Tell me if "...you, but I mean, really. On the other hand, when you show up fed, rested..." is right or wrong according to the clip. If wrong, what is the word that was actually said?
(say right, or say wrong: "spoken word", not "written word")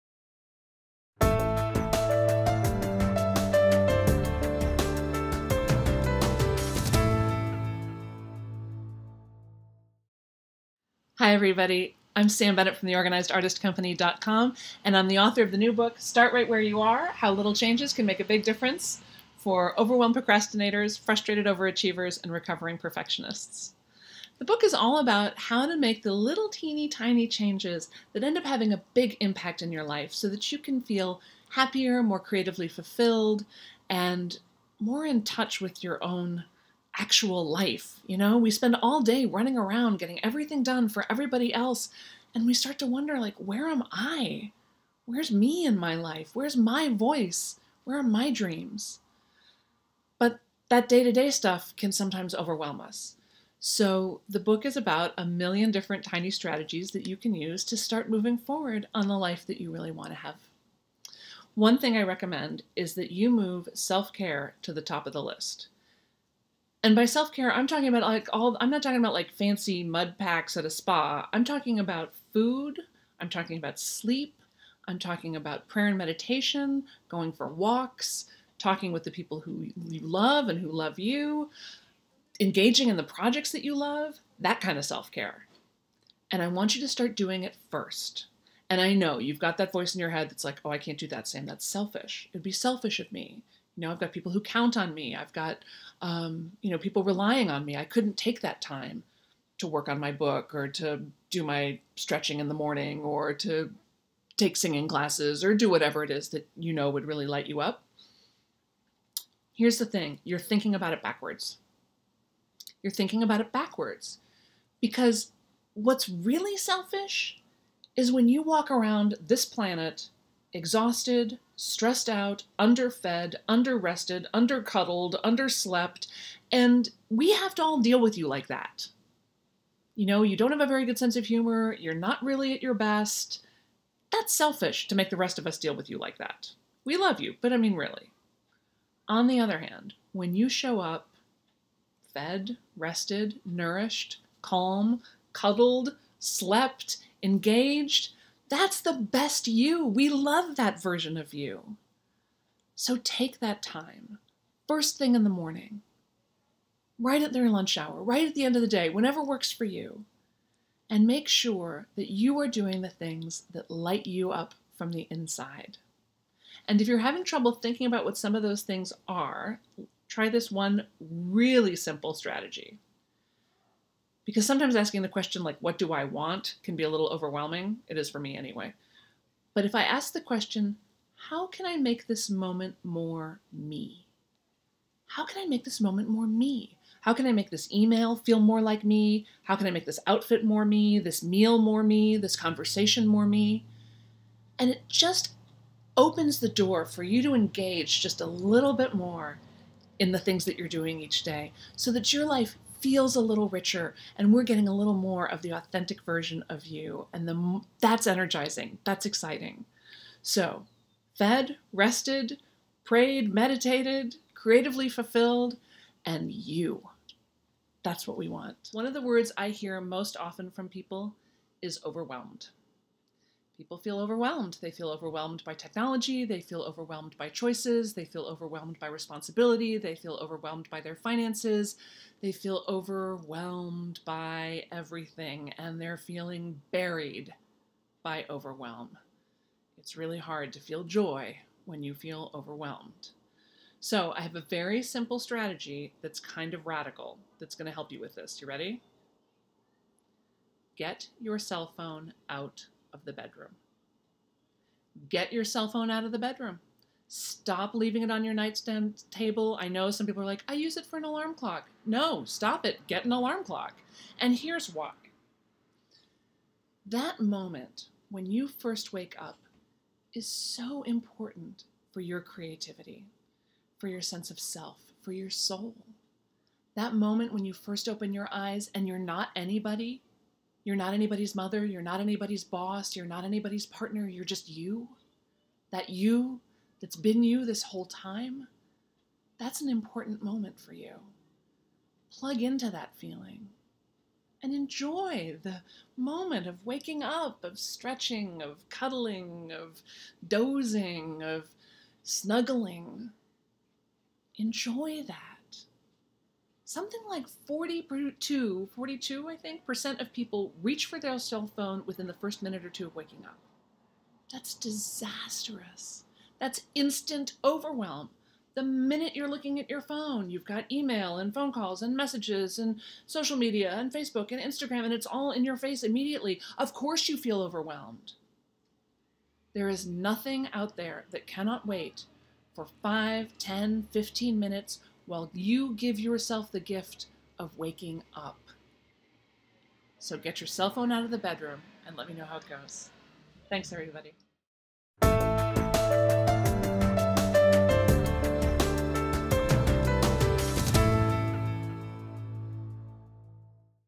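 right.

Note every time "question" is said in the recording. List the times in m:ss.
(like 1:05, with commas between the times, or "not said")
2:55, 3:00.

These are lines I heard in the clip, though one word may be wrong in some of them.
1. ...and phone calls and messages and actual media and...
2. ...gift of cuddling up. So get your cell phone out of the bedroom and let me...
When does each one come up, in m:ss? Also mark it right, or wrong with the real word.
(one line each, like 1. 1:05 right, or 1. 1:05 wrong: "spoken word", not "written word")
1. 5:21 wrong: "social", not "actual"
2. 5:36 wrong: "waking", not "cuddling".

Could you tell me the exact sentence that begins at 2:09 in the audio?
You know, you don't have a very good sense of humor, you're not really at your best.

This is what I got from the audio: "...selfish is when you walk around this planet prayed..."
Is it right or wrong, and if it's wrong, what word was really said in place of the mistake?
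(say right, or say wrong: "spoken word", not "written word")
wrong: "exhausted", not "prayed".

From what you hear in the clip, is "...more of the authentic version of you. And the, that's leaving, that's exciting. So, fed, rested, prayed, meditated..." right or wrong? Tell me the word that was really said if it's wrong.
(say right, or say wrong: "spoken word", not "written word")
wrong: "energizing", not "leaving".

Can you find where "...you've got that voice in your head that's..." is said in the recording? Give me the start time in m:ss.
1:29.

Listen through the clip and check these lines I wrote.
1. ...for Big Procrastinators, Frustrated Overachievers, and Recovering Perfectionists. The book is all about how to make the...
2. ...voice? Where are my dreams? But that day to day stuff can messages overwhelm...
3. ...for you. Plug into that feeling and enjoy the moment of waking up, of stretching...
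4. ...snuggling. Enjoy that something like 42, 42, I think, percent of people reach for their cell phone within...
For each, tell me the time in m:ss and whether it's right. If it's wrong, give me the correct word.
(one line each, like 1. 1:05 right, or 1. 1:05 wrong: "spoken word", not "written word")
1. 0:19 wrong: "Overwhelmed", not "Big"
2. 0:46 wrong: "sometimes", not "messages"
3. 4:50 right
4. 5:02 right.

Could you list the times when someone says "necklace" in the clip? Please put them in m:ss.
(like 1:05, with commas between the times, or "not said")
not said.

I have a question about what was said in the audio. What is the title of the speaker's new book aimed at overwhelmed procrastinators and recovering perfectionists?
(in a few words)
Start Right Where You Are.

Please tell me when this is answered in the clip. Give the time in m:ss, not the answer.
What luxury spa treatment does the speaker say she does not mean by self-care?
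1:09.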